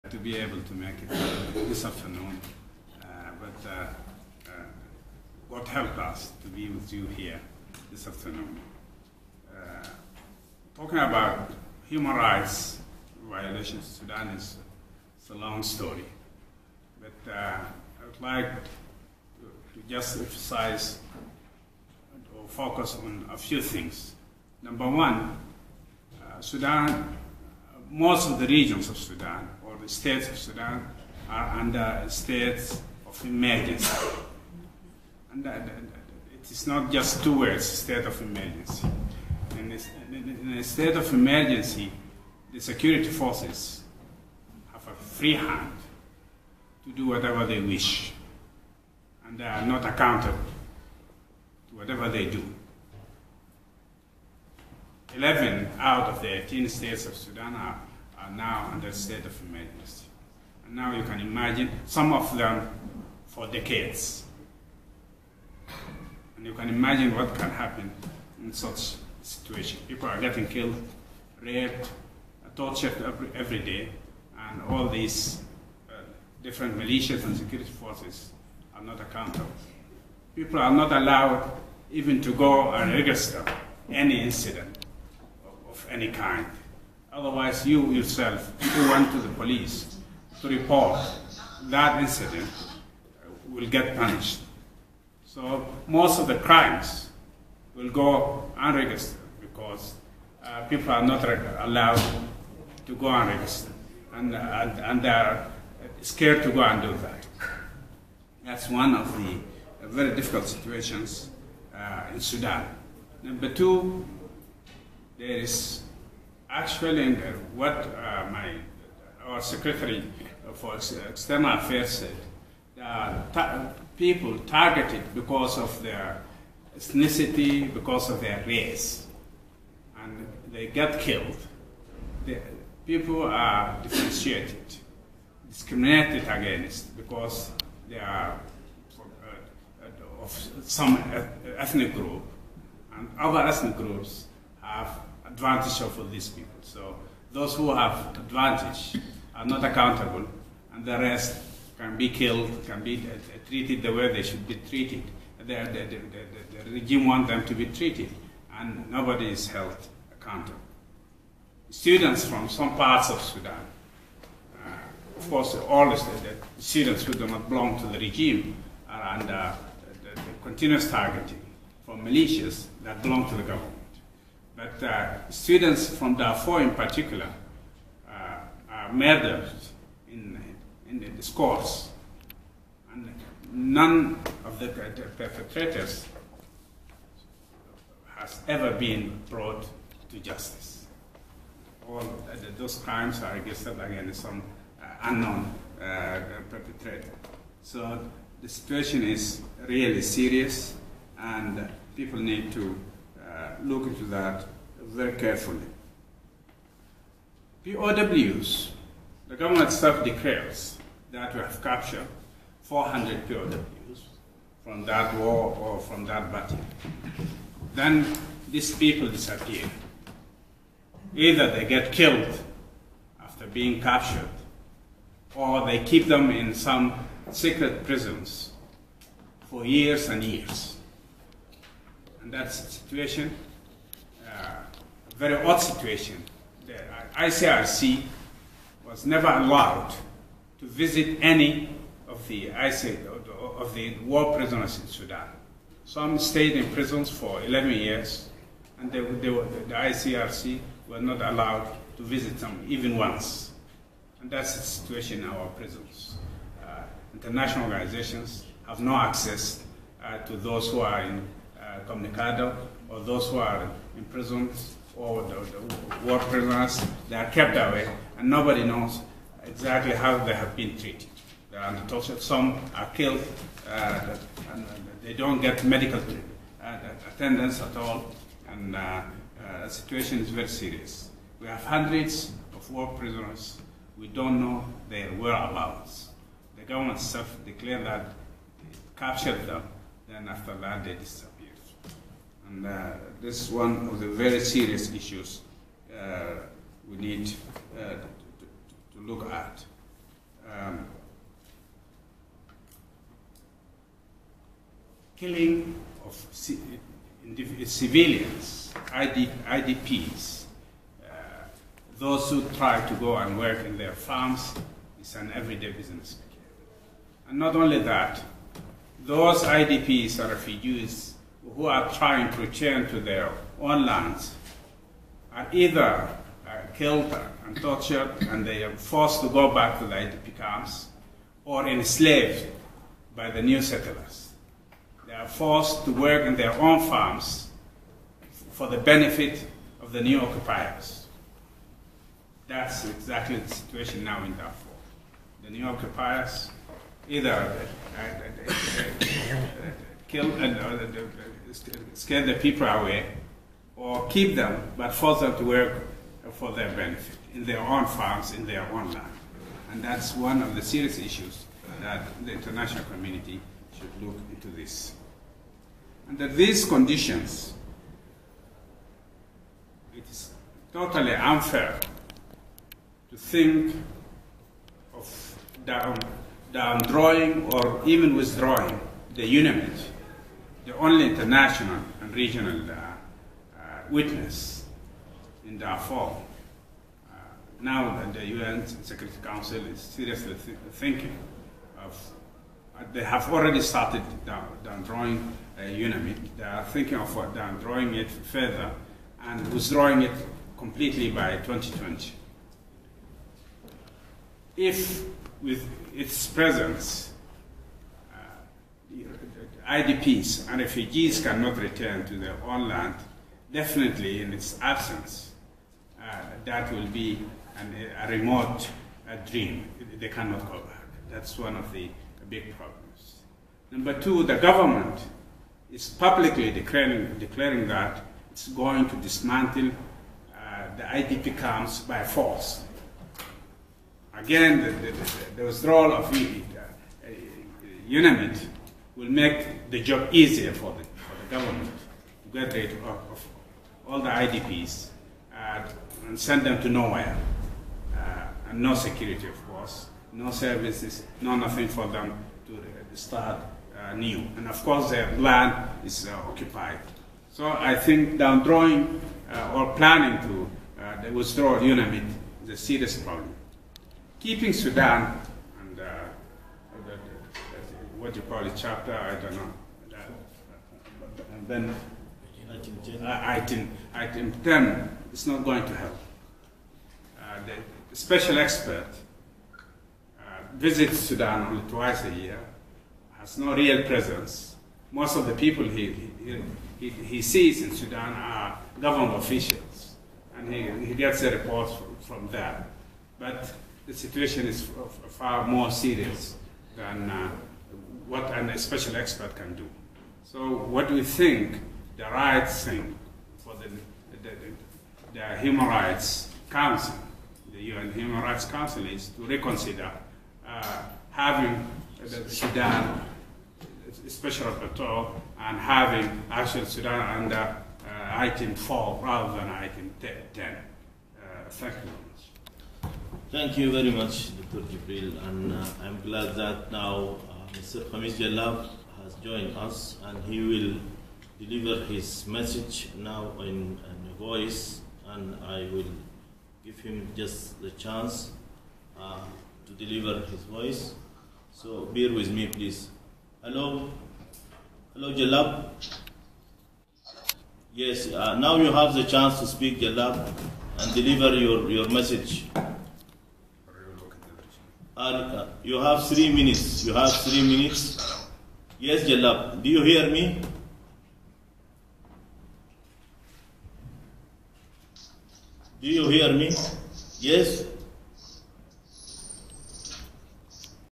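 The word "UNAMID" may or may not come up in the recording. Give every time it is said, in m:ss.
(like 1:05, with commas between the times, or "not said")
6:19, 6:35, 7:17, 7:41.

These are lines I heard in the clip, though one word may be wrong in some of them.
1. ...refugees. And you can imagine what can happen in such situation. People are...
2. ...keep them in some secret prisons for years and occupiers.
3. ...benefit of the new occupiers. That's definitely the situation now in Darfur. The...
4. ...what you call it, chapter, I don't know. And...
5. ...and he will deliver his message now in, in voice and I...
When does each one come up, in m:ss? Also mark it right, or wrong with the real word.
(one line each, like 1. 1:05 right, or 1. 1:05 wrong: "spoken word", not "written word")
1. 1:03 wrong: "decades", not "refugees"
2. 3:45 wrong: "years", not "occupiers"
3. 5:38 wrong: "exactly", not "definitely"
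4. 7:48 right
5. 8:50 right.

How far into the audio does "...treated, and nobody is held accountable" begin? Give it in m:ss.
2:37.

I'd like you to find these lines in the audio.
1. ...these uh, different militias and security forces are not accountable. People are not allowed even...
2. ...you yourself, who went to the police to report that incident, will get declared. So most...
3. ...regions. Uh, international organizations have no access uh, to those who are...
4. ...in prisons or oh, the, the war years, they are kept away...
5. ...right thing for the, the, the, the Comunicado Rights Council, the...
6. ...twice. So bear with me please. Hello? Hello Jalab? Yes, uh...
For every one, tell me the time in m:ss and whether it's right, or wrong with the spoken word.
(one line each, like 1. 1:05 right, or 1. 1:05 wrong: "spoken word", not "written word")
1. 1:14 right
2. 1:27 wrong: "punished", not "declared"
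3. 4:15 wrong: "prisons", not "regions"
4. 4:23 wrong: "prisoners", not "years"
5. 8:22 wrong: "Human", not "Comunicado"
6. 9:00 wrong: "voice", not "twice".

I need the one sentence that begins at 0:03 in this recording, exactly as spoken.
Uh, but uh, what helped us to be with you here this afternoon.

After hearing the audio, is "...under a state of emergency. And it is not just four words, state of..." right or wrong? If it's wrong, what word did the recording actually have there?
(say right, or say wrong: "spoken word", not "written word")
wrong: "two", not "four".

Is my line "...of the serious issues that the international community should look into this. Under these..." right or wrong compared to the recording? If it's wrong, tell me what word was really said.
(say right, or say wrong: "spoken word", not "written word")
right.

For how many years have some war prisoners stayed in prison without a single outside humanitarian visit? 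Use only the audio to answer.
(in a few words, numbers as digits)
11 years.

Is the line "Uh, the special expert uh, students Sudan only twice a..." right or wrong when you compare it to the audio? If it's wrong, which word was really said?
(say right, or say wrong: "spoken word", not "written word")
wrong: "visits", not "students".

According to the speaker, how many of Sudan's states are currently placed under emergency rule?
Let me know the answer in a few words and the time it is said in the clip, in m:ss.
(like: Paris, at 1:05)
11, at 0:55.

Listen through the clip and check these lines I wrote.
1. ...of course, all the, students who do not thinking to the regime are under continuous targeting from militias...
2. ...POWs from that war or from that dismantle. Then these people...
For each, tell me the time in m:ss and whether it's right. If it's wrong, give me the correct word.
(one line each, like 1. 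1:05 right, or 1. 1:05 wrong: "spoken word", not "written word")
1. 2:45 wrong: "belong", not "thinking"
2. 3:33 wrong: "battle", not "dismantle".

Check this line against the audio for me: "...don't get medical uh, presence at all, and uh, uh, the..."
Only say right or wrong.
wrong.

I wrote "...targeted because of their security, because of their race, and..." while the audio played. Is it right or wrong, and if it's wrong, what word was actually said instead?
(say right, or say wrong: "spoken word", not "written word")
wrong: "ethnicity", not "security".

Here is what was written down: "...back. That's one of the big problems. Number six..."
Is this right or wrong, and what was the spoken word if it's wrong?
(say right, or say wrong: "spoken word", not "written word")
wrong: "two", not "six".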